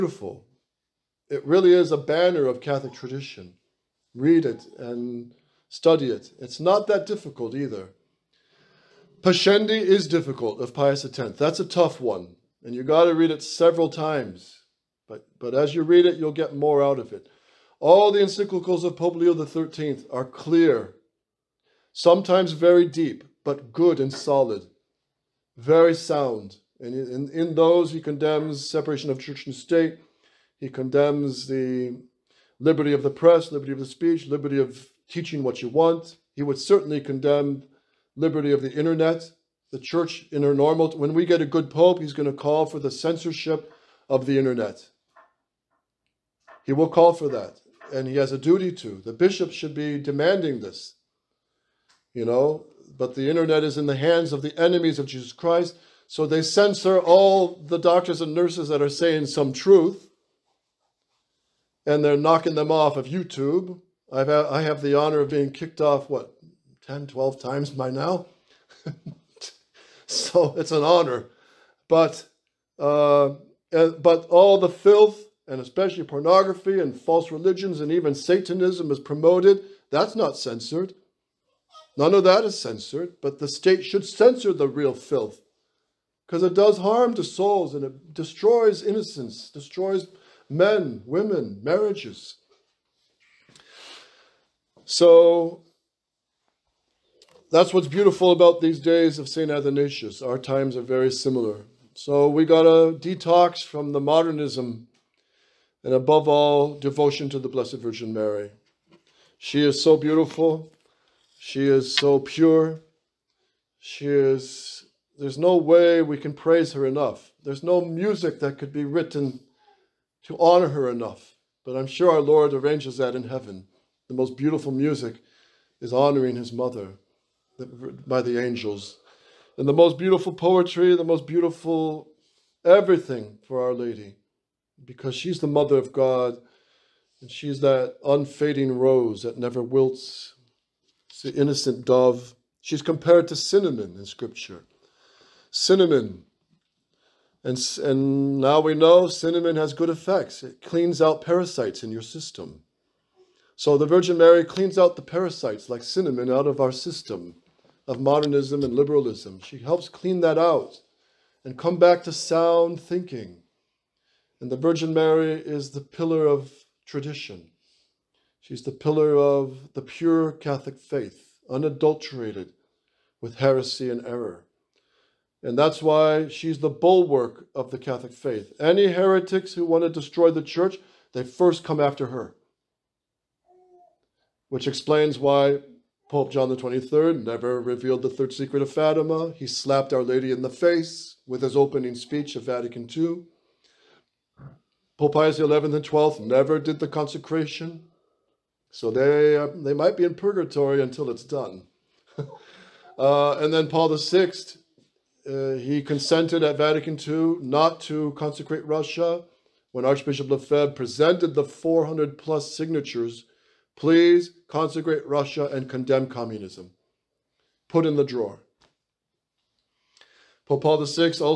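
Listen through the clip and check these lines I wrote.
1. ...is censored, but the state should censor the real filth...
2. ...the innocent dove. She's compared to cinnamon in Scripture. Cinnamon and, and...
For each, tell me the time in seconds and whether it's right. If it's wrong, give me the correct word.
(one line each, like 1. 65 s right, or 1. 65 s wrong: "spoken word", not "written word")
1. 82 s right
2. 141 s right.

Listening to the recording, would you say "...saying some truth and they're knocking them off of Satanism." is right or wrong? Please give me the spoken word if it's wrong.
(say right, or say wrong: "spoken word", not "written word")
wrong: "YouTube", not "Satanism".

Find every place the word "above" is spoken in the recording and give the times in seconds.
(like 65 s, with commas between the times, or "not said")
105 s.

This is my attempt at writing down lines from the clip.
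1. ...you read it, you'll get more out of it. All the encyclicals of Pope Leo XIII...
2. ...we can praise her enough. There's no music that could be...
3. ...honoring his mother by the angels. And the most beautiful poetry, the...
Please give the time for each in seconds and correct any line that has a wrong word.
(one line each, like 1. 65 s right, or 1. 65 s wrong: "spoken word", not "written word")
1. 15 s right
2. 116 s right
3. 125 s right.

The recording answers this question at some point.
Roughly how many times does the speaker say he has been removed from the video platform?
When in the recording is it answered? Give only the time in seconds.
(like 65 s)
66 s.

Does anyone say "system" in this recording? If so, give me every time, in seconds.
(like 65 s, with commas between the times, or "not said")
152 s, 156 s.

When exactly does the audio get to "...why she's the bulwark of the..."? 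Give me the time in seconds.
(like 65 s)
175 s.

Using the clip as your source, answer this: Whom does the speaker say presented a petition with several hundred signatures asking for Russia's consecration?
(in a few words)
Archbishop Lefebvre.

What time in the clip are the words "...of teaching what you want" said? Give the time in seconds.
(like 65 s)
34 s.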